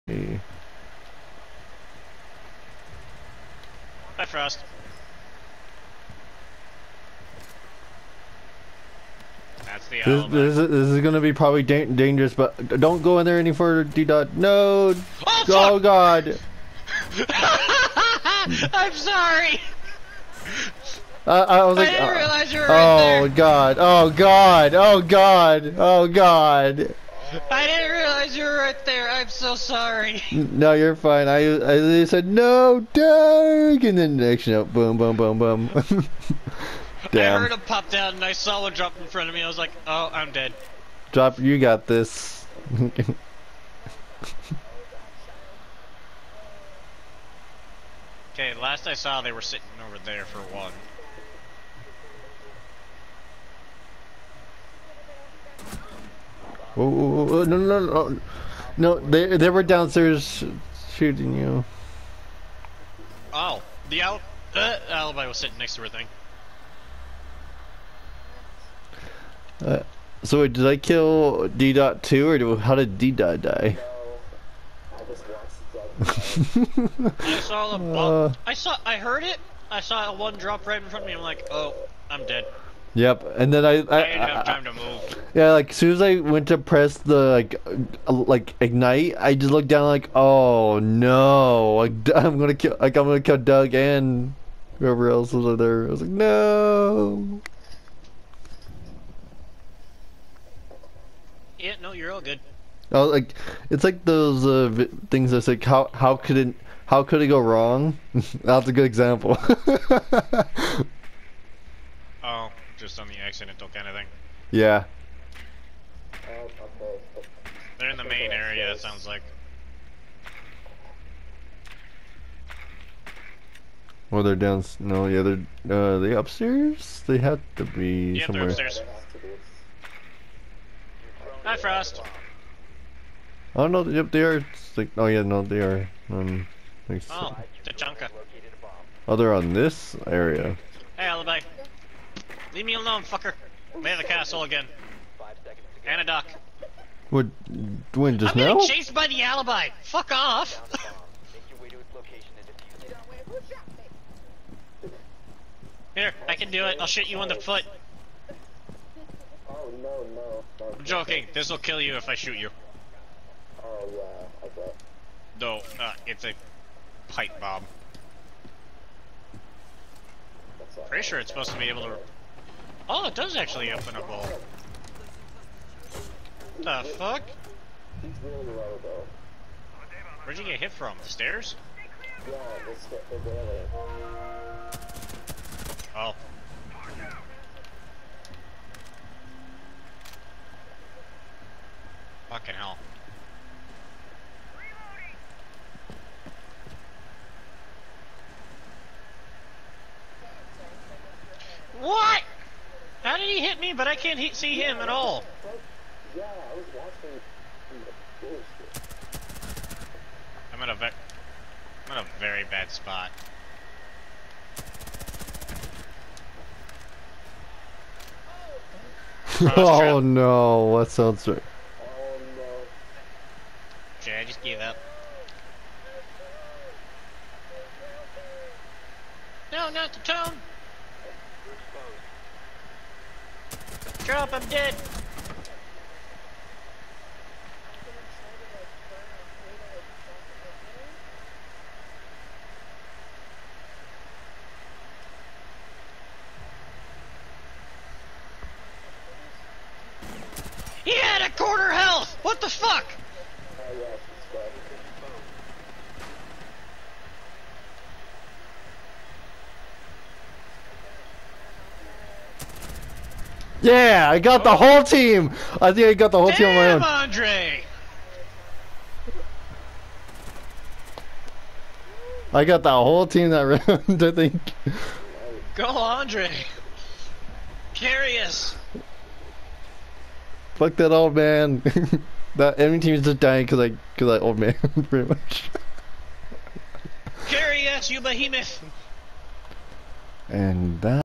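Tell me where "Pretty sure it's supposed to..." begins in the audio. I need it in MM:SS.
02:50.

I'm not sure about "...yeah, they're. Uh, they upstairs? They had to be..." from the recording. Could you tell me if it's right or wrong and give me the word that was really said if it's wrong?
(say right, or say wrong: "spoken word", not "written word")
right.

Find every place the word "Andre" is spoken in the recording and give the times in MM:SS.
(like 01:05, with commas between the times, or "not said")
04:26, 04:35.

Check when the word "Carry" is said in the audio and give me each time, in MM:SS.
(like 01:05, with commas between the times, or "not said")
04:37, 04:47.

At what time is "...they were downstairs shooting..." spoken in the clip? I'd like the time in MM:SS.
00:59.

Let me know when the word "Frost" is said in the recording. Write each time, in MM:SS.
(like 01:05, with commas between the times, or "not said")
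00:04, 02:11.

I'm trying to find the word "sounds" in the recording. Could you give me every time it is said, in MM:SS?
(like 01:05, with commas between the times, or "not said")
01:58, 03:40.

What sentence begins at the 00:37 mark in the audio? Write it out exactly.
I heard him pop down, and I saw one drop in front of me.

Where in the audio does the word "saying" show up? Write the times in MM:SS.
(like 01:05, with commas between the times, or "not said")
not said.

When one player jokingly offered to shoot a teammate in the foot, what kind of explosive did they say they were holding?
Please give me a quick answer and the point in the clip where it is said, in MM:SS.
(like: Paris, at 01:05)
pipe bomb, at 02:47.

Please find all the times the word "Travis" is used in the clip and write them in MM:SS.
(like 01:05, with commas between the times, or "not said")
not said.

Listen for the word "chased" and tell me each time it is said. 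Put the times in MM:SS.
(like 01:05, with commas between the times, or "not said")
02:28.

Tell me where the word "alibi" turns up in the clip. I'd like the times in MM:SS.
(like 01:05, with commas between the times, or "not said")
01:04, 02:21, 02:29.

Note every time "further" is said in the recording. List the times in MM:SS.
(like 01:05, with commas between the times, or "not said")
00:13.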